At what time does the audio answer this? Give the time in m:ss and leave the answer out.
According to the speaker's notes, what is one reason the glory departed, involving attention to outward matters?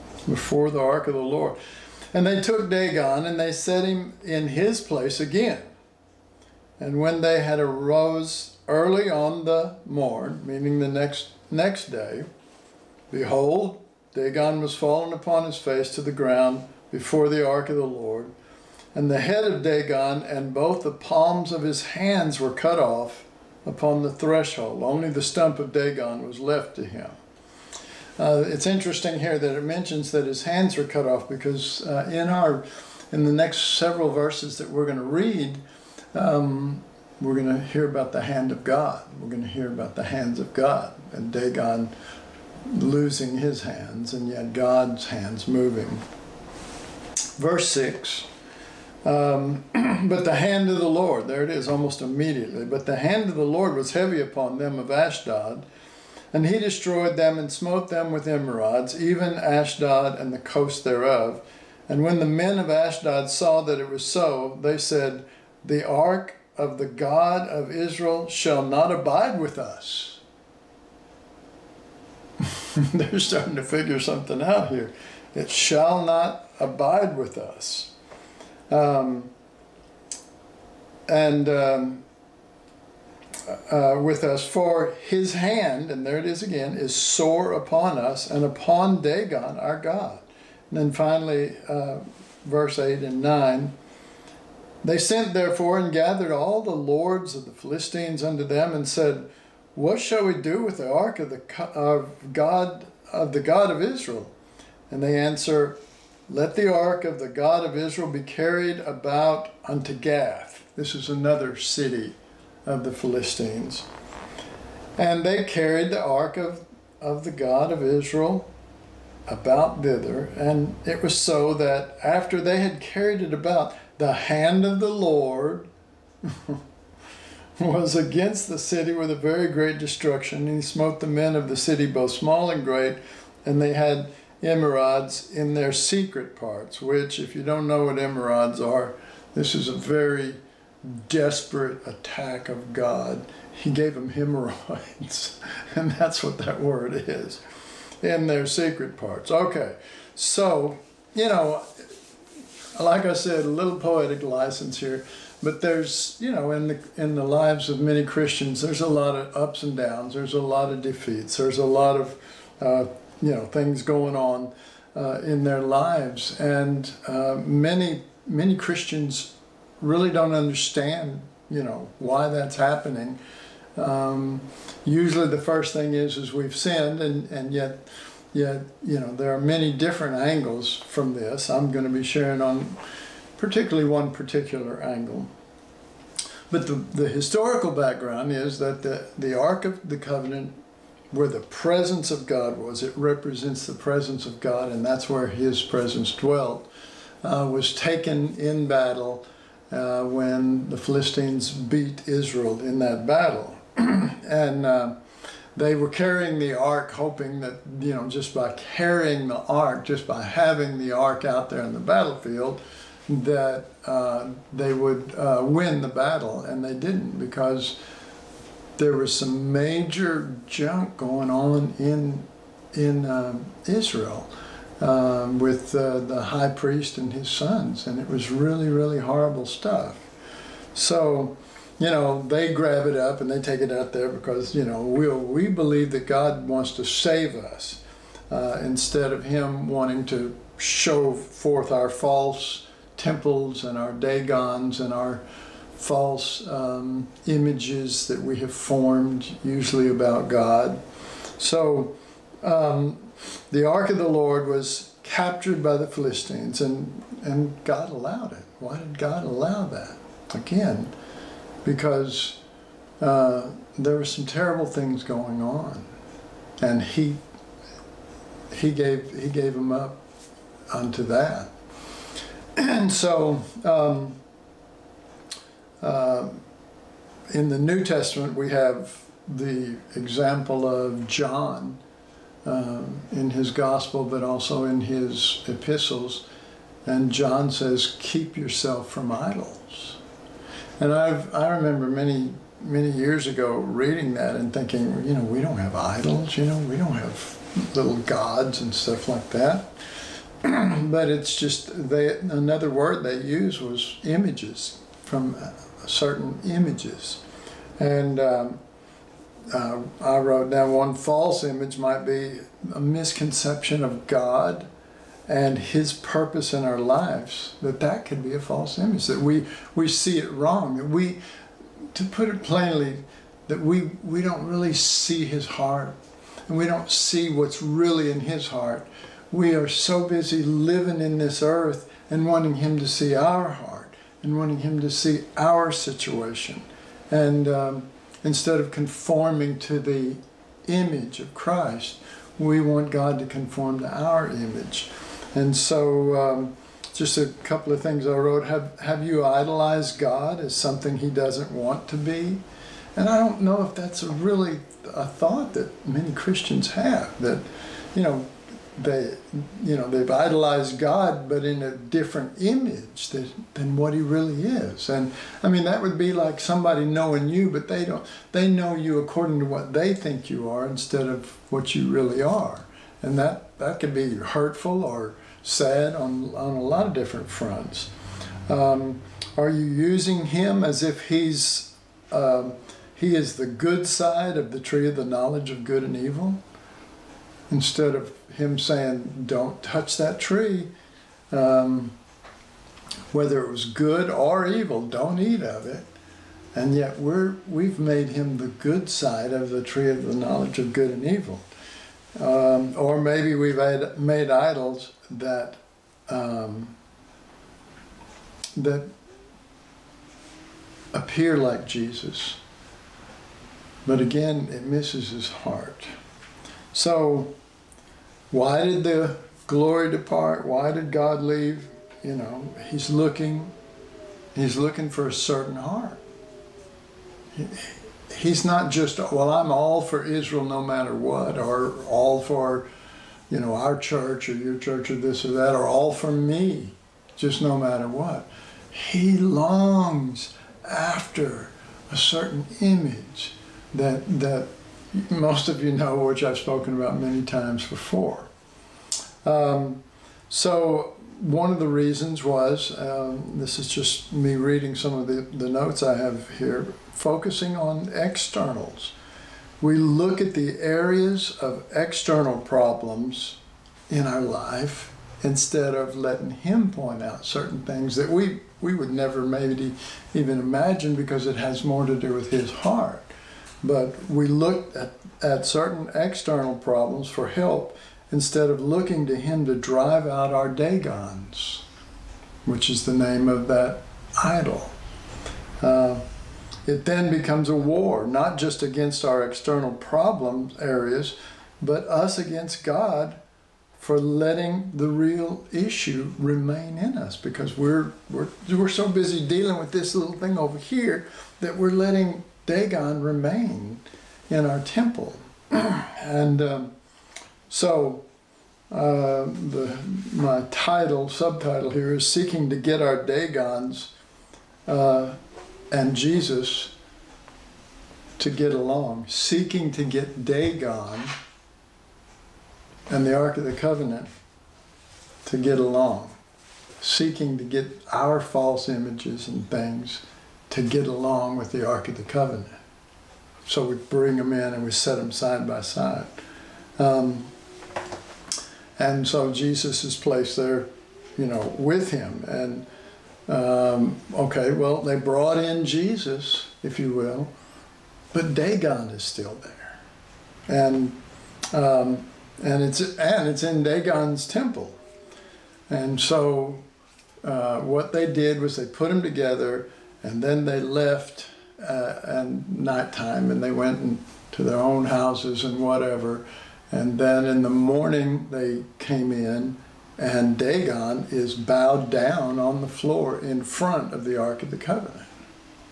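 7:36.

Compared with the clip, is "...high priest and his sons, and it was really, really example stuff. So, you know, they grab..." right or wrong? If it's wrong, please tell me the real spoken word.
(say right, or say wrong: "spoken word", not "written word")
wrong: "horrible", not "example".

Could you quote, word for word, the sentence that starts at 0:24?
Only the stump of Dagon was left to him.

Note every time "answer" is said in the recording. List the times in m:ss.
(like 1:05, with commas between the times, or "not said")
1:45.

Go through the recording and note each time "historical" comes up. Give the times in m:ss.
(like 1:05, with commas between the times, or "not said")
3:07.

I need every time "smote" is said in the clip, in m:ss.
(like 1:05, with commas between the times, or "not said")
0:57, 2:10.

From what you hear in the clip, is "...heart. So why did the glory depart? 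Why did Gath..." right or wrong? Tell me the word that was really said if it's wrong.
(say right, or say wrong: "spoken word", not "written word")
wrong: "God", not "Gath".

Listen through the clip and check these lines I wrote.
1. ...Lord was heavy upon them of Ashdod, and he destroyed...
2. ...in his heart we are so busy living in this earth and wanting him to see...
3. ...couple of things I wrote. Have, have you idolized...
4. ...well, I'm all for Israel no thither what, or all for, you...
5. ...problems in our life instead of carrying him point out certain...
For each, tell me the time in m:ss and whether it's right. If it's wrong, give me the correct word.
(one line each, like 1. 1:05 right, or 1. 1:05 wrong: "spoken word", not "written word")
1. 0:53 right
2. 5:28 right
3. 5:47 right
4. 7:08 wrong: "matter", not "thither"
5. 7:42 wrong: "letting", not "carrying".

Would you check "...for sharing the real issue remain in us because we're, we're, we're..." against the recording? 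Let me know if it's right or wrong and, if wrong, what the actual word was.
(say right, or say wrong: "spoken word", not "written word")
wrong: "letting", not "sharing".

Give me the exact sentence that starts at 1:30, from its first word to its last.
And then finally, uh, verse 8 and 9.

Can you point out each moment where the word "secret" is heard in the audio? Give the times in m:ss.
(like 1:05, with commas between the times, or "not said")
2:15, 2:28.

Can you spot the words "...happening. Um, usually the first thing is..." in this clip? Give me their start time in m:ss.
2:52.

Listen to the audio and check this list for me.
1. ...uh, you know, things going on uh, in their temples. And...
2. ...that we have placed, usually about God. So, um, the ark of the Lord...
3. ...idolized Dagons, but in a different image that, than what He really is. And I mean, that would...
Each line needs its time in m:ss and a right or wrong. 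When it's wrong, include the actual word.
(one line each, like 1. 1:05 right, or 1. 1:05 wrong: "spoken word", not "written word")
1. 2:42 wrong: "lives", not "temples"
2. 4:08 wrong: "formed", not "placed"
3. 6:00 wrong: "God", not "Dagons".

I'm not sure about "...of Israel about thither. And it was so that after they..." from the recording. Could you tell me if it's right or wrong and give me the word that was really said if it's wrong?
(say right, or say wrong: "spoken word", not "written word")
right.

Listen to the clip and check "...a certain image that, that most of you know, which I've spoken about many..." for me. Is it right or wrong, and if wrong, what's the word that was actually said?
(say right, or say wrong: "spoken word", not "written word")
right.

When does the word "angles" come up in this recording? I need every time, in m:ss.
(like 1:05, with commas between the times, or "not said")
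3:00, 3:04.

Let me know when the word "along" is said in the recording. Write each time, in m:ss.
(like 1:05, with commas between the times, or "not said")
8:38, 8:45, 8:50.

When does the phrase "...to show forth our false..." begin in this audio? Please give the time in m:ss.
4:00.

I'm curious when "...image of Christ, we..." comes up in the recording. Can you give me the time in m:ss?
5:40.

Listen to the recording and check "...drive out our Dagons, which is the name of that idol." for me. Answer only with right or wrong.
right.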